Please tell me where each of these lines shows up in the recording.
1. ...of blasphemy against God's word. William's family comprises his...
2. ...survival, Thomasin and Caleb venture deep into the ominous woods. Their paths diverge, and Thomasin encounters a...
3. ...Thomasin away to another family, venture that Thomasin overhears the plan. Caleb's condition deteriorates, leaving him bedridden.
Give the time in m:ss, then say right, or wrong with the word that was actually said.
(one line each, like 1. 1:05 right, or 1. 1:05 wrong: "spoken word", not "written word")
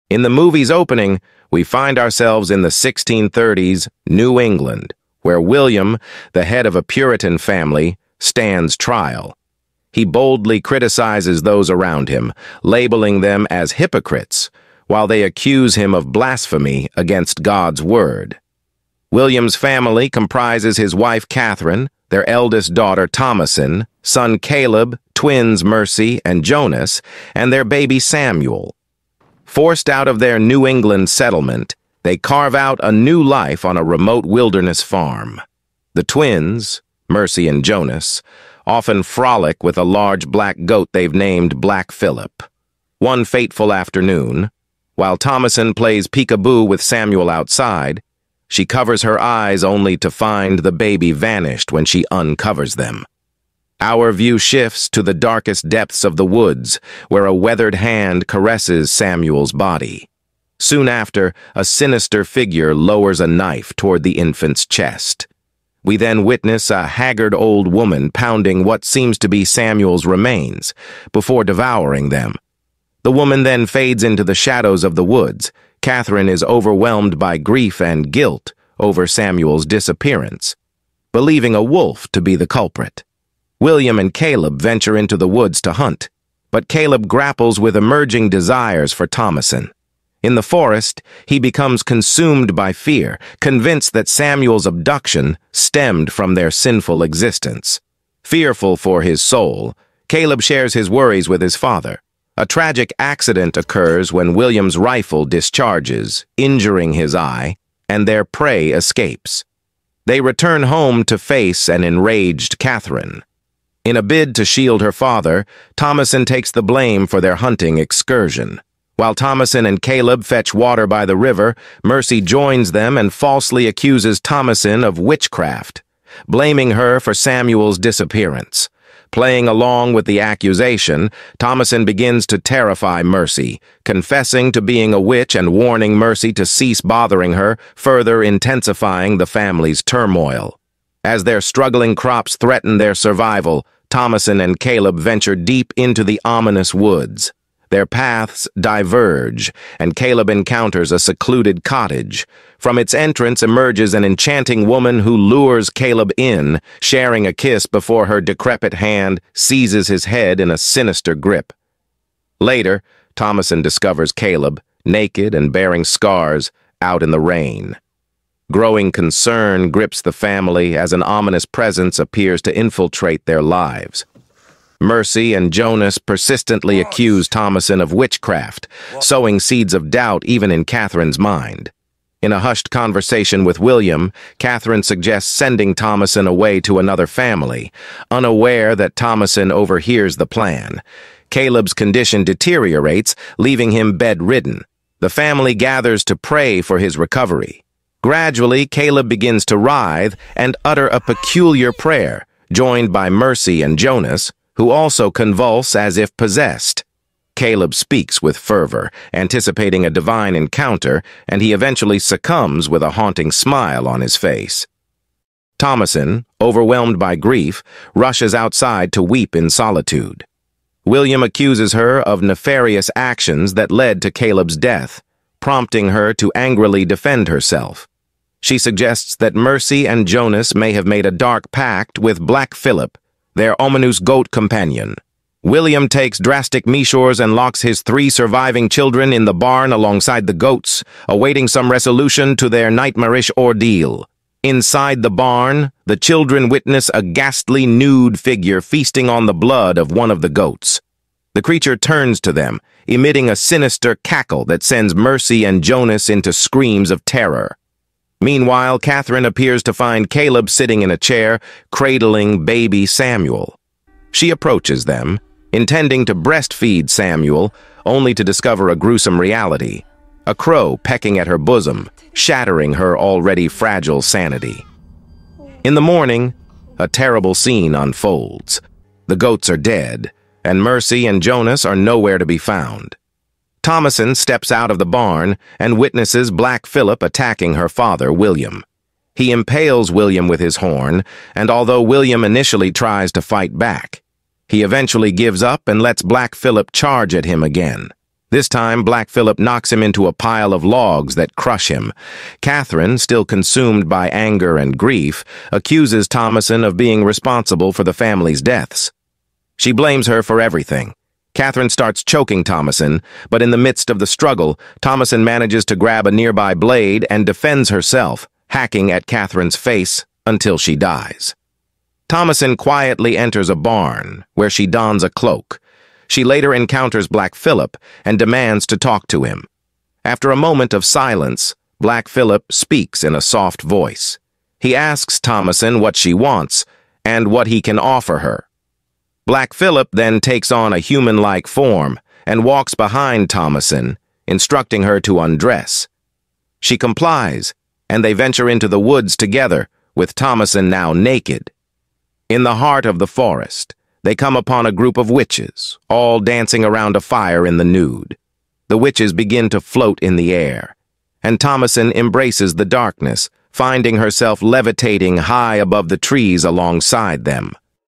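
1. 0:15 right
2. 2:22 wrong: "Caleb", not "Thomasin"
3. 3:05 wrong: "unaware", not "venture".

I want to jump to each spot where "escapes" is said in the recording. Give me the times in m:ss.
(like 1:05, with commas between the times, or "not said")
1:48.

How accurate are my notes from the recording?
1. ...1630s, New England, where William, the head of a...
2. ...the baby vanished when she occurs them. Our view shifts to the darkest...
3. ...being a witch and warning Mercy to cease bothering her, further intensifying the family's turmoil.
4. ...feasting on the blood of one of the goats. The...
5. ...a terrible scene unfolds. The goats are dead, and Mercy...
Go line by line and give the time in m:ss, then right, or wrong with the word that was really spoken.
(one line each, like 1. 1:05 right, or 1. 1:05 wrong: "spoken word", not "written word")
1. 0:02 right
2. 0:50 wrong: "uncovers", not "occurs"
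3. 2:14 right
4. 4:08 right
5. 4:36 right.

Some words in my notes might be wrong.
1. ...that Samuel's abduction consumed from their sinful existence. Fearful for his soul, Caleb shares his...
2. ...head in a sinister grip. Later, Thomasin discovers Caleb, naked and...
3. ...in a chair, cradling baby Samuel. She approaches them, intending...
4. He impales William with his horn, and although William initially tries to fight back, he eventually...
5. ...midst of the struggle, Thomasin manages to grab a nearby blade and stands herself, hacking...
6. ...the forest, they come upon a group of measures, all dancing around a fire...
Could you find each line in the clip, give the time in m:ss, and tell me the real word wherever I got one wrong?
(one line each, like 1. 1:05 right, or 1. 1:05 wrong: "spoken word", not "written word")
1. 1:33 wrong: "stemmed", not "consumed"
2. 2:40 right
3. 4:20 right
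4. 4:49 right
5. 5:13 wrong: "defends", not "stands"
6. 5:52 wrong: "witches", not "measures".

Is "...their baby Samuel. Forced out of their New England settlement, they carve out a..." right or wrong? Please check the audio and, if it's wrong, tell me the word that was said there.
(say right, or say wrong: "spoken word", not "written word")
right.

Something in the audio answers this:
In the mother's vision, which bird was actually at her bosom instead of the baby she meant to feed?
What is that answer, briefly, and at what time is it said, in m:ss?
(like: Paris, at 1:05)
A crow, at 4:30.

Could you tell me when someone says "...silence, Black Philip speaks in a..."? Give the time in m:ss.
5:30.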